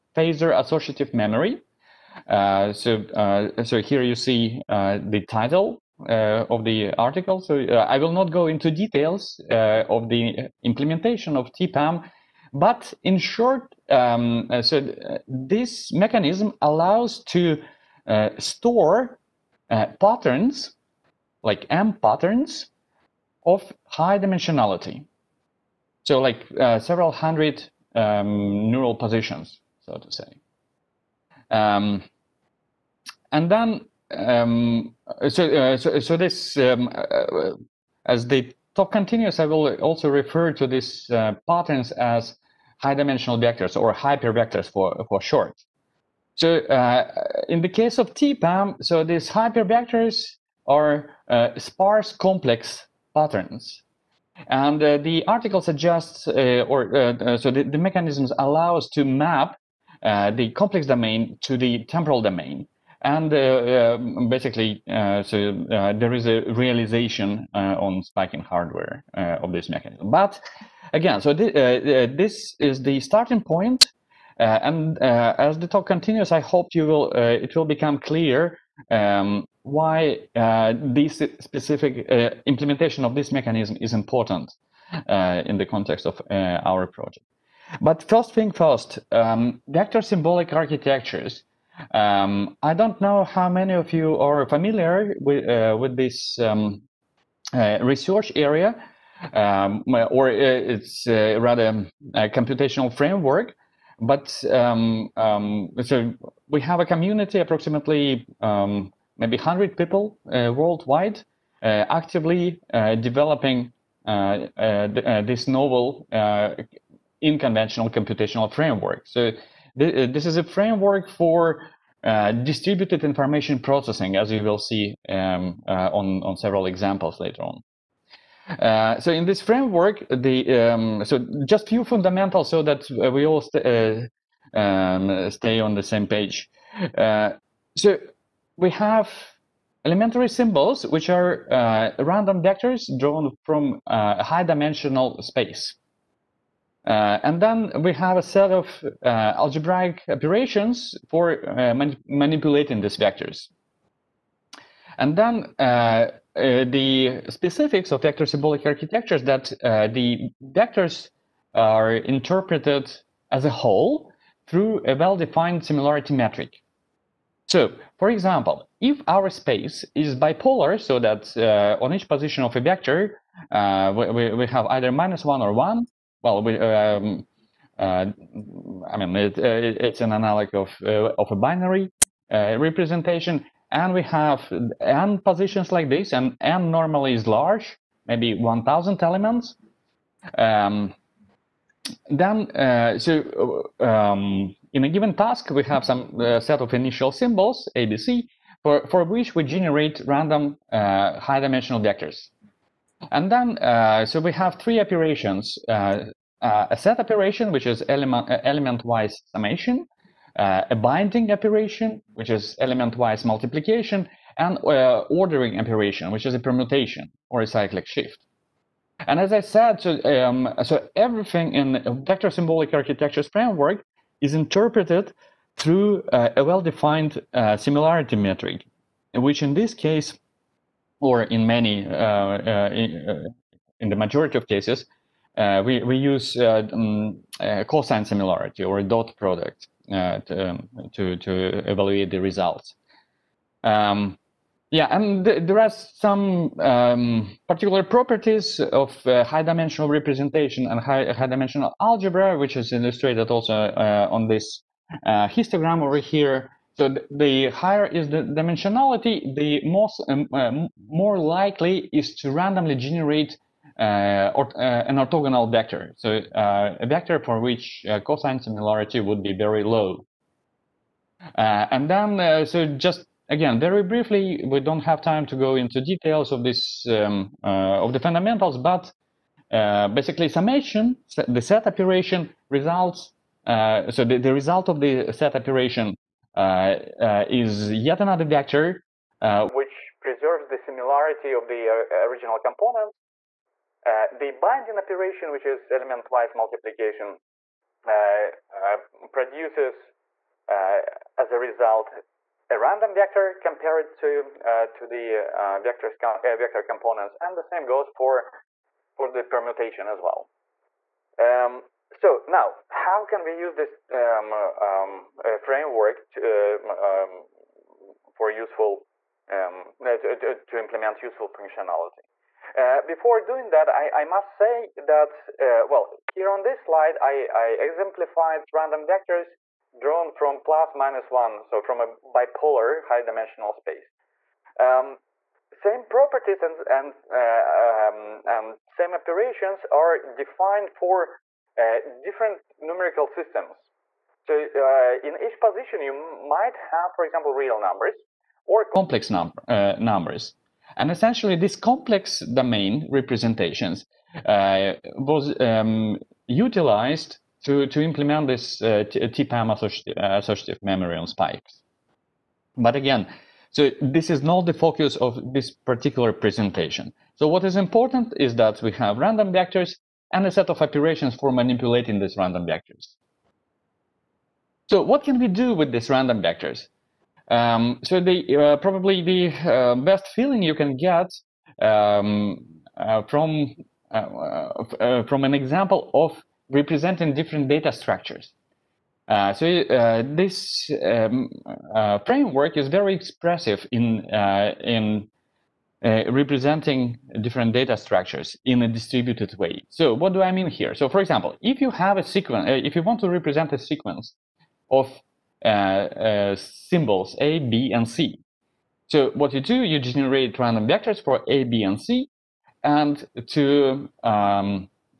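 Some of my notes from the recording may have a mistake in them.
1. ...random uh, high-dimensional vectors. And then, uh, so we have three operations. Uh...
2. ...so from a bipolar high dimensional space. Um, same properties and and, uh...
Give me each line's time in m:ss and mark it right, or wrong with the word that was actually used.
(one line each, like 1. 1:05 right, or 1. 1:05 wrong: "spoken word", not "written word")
1. 3:20 right
2. 5:31 right.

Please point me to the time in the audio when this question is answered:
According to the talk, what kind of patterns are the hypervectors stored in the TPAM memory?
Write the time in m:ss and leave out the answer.
0:51.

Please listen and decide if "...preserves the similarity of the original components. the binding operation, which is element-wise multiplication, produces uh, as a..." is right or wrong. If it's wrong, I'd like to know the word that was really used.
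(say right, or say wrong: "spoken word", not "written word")
right.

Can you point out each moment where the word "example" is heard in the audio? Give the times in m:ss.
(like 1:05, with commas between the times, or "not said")
2:06, 2:48, 5:47, 6:25, 6:41.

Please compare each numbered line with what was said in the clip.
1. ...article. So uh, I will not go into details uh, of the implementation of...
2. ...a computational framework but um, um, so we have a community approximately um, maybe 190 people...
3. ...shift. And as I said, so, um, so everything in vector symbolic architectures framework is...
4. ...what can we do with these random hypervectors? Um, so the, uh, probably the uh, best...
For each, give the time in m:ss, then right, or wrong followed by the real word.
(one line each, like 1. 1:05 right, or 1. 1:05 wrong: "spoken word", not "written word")
1. 0:06 right
2. 1:42 wrong: "100", not "190"
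3. 3:37 right
4. 6:14 wrong: "vectors", not "hypervectors".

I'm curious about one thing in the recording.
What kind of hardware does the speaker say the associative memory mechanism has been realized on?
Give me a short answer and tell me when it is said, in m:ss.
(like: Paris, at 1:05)
spiking hardware, at 1:08.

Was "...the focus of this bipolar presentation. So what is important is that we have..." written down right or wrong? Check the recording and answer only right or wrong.
wrong.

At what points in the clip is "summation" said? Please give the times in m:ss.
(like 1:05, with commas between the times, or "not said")
3:29, 4:40.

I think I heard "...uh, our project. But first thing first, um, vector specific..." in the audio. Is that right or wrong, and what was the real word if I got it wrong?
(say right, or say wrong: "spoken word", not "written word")
wrong: "symbolic", not "specific".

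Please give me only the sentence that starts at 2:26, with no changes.
Uh, and then we have a set of uh, algebraic operations for uh, man manipulating these vectors.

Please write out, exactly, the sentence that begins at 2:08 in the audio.
Uh, so in this framework, the um, so just few fundamentals so that we all st- um, stay on the same page.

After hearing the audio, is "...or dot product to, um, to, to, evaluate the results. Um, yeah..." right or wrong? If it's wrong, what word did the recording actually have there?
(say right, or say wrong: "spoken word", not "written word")
right.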